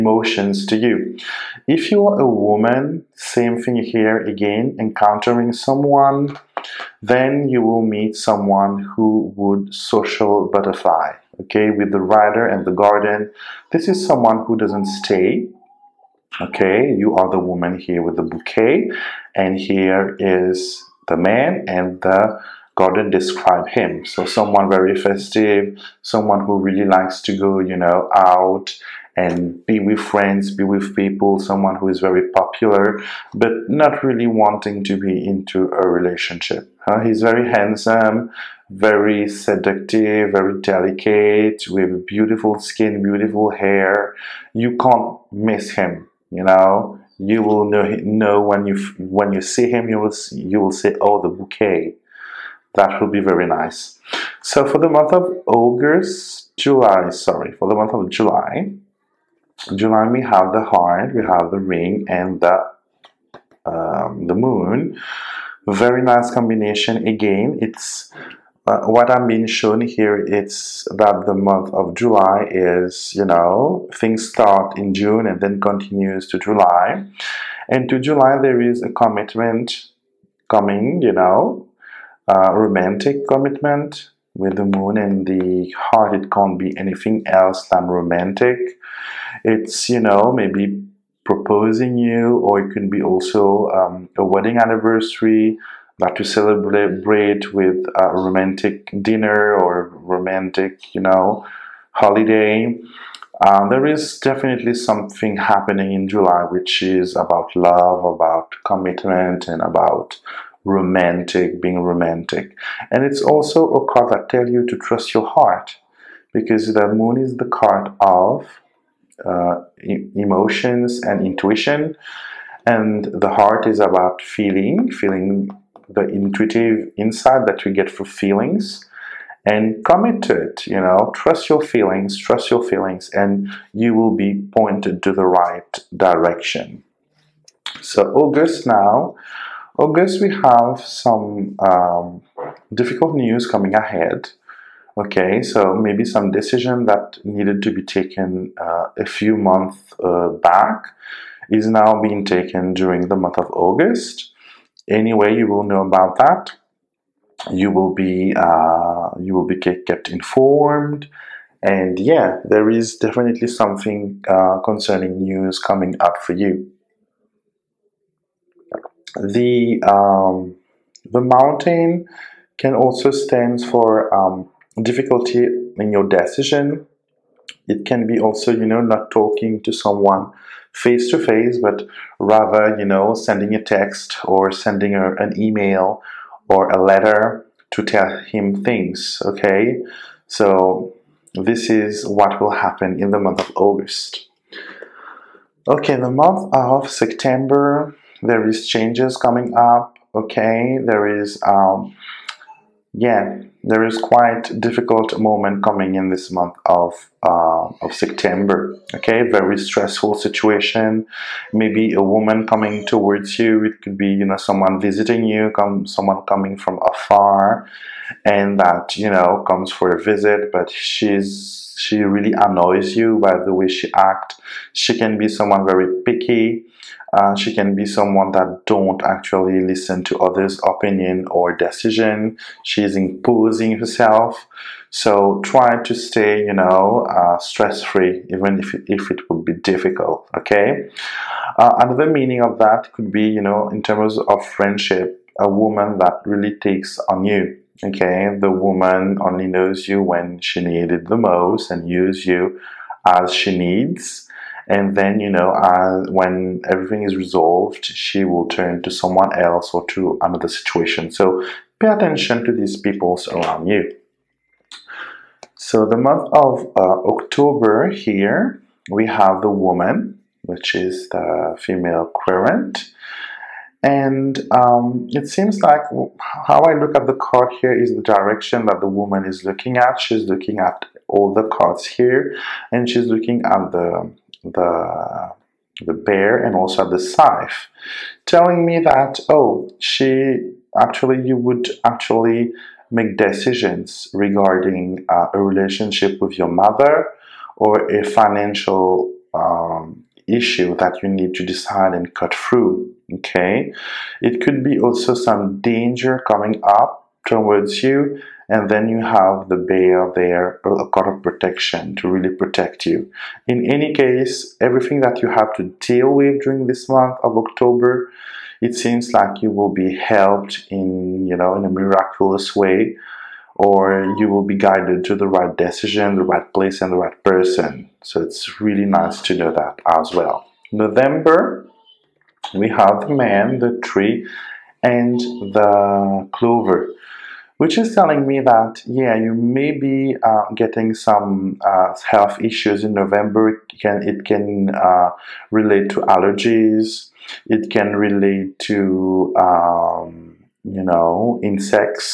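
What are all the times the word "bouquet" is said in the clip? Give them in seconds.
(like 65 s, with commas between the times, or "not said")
18 s, 51 s.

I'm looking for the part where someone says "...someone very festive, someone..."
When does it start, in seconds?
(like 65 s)
24 s.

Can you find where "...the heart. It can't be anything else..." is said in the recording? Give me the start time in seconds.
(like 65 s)
85 s.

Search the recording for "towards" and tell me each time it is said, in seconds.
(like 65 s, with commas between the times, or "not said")
212 s, 307 s.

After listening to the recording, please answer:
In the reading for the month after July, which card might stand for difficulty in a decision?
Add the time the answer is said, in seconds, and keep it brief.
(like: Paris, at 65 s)
The mountain, at 171 s.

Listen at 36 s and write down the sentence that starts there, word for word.
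Uh, he's very handsome, very seductive, very delicate, with beautiful skin, beautiful hair.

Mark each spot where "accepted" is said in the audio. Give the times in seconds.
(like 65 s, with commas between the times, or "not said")
not said.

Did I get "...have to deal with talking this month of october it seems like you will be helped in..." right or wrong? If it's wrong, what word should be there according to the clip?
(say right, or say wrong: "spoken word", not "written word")
wrong: "during", not "talking".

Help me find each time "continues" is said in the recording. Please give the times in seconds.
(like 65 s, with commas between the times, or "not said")
75 s.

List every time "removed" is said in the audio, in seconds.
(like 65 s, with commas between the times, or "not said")
not said.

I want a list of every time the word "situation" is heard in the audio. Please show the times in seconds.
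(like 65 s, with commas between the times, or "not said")
210 s, 260 s.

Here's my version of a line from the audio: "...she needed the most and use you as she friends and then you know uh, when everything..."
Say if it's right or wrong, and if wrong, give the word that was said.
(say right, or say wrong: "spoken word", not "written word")
wrong: "needs", not "friends".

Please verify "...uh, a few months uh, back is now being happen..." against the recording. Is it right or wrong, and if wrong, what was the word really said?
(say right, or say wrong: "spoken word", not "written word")
wrong: "taken", not "happen".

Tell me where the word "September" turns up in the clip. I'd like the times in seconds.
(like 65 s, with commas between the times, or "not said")
196 s, 207 s.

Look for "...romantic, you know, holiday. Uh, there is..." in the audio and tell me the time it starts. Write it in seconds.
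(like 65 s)
99 s.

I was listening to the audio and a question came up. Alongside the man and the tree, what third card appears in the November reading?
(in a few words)
The clover.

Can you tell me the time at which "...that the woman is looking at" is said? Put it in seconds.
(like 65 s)
278 s.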